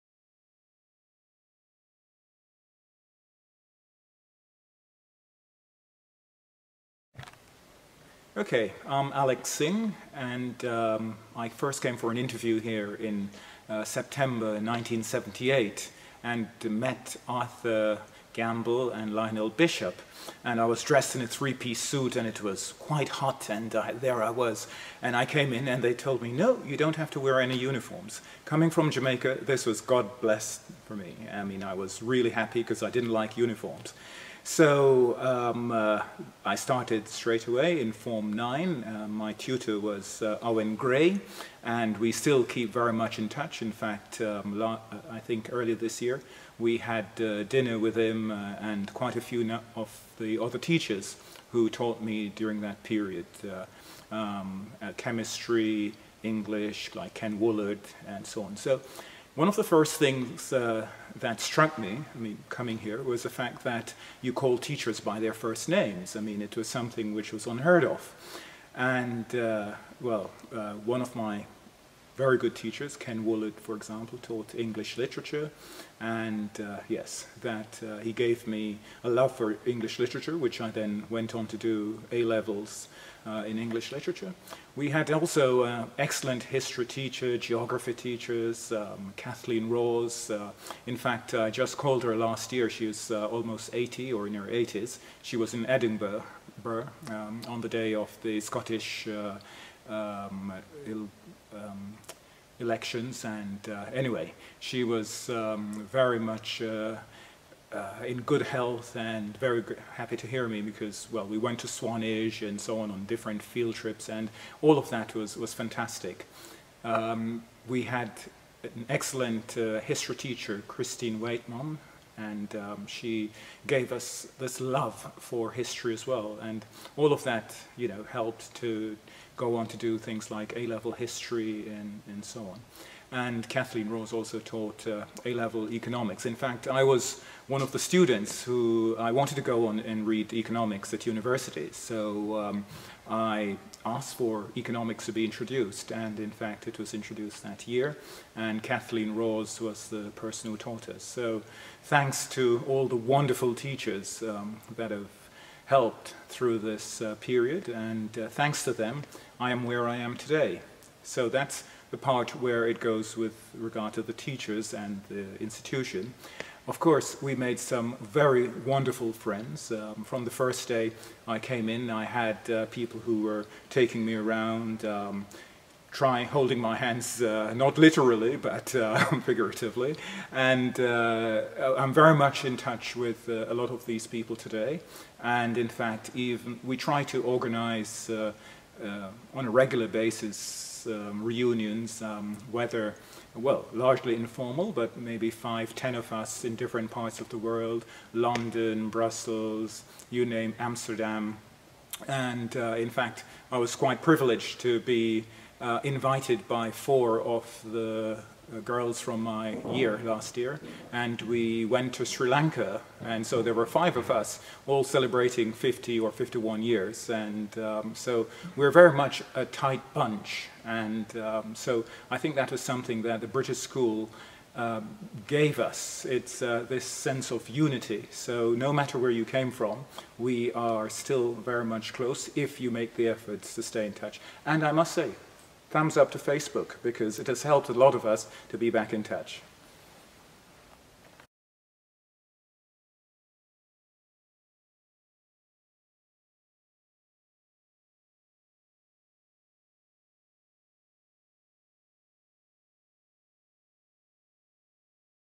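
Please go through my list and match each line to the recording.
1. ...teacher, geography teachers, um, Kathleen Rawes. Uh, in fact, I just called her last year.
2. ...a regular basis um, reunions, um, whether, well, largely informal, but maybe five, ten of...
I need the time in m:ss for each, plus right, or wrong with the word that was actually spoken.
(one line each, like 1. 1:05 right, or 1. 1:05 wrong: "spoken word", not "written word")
1. 1:26 right
2. 3:09 right.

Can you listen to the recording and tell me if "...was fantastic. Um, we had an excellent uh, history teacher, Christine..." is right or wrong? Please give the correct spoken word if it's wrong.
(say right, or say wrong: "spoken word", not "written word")
right.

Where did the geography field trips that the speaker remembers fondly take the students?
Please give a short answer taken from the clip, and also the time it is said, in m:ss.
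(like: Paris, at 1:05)
Swanage, at 1:51.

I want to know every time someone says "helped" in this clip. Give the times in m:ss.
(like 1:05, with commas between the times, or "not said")
2:08, 2:35, 3:57.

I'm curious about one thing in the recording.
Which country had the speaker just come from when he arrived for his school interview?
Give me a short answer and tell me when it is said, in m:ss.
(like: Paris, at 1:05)
Jamaica, at 0:28.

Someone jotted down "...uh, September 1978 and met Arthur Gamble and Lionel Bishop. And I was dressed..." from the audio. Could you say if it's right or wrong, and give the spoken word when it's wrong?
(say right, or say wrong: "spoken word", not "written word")
right.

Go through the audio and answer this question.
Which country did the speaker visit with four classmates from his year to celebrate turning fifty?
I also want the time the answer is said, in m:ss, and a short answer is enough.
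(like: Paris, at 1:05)
Sri Lanka, at 3:32.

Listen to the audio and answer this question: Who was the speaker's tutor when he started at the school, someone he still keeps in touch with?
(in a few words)
Owen Gray.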